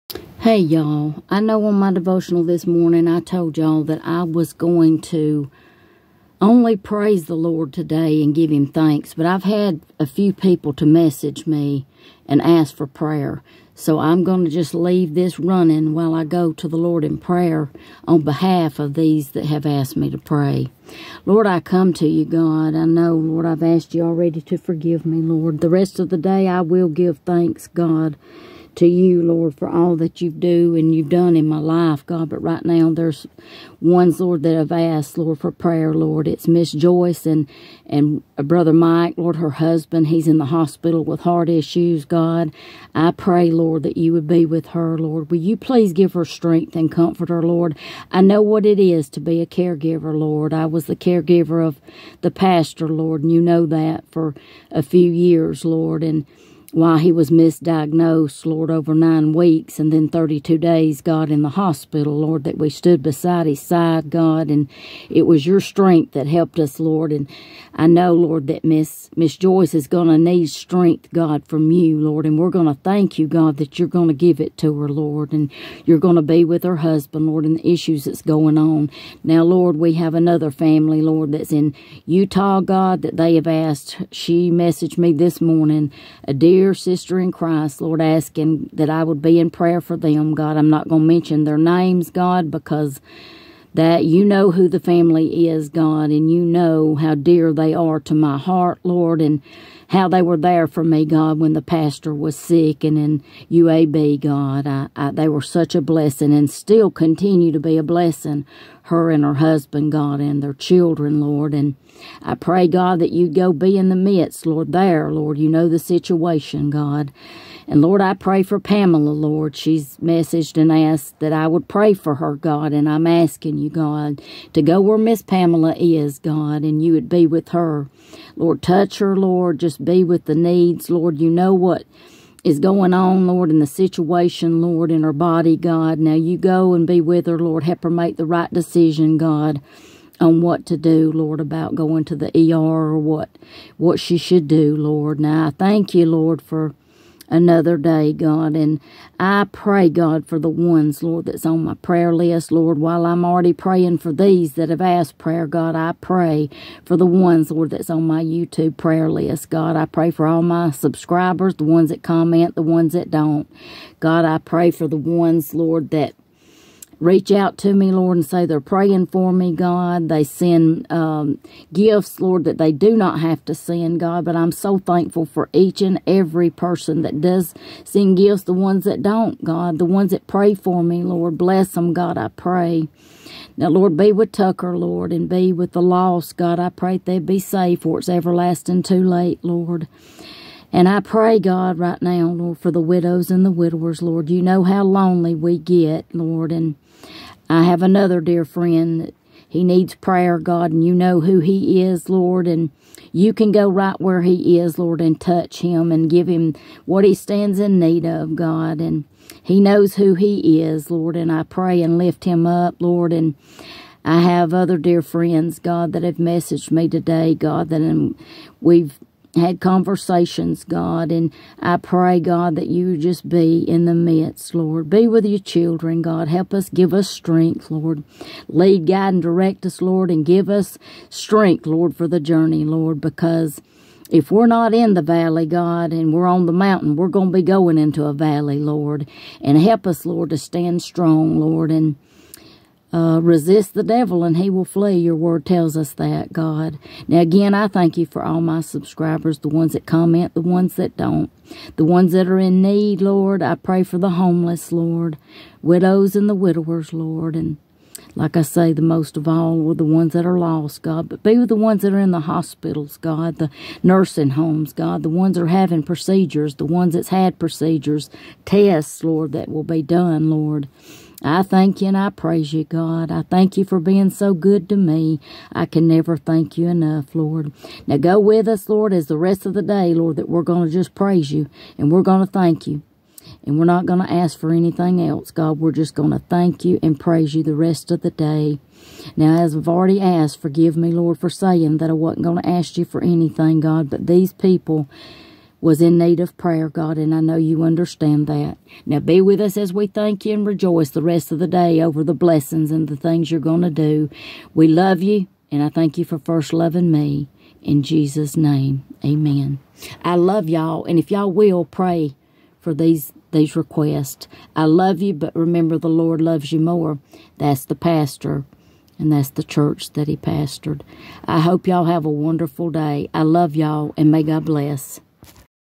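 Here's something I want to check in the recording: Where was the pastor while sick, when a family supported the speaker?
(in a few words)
UAB.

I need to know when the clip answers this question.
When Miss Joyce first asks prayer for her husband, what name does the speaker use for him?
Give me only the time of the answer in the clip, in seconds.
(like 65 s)
38 s.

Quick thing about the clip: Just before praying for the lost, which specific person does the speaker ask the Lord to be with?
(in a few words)
Tucker.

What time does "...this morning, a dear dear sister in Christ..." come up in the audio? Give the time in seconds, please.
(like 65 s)
85 s.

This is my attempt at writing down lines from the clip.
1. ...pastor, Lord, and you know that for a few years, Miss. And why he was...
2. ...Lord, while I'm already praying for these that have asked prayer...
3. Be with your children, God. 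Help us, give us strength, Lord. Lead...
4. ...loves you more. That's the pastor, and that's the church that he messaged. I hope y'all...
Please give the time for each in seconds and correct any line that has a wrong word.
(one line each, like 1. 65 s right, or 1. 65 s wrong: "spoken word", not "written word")
1. 52 s wrong: "Lord", not "Miss"
2. 152 s right
3. 224 s right
4. 316 s wrong: "pastored", not "messaged".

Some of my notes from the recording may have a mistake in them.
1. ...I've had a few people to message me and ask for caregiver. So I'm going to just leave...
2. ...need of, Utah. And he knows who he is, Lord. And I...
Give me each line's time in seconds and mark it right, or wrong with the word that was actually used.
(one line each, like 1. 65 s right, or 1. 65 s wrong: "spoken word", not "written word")
1. 9 s wrong: "prayer", not "caregiver"
2. 207 s wrong: "God", not "Utah".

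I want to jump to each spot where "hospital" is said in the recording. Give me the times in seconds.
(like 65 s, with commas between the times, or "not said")
40 s, 61 s, 262 s.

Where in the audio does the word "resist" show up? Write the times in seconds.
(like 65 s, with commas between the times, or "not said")
243 s.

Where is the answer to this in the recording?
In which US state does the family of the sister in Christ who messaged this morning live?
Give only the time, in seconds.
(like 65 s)
82 s.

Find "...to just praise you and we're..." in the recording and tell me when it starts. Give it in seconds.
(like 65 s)
280 s.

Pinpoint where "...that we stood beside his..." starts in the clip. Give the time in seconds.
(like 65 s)
62 s.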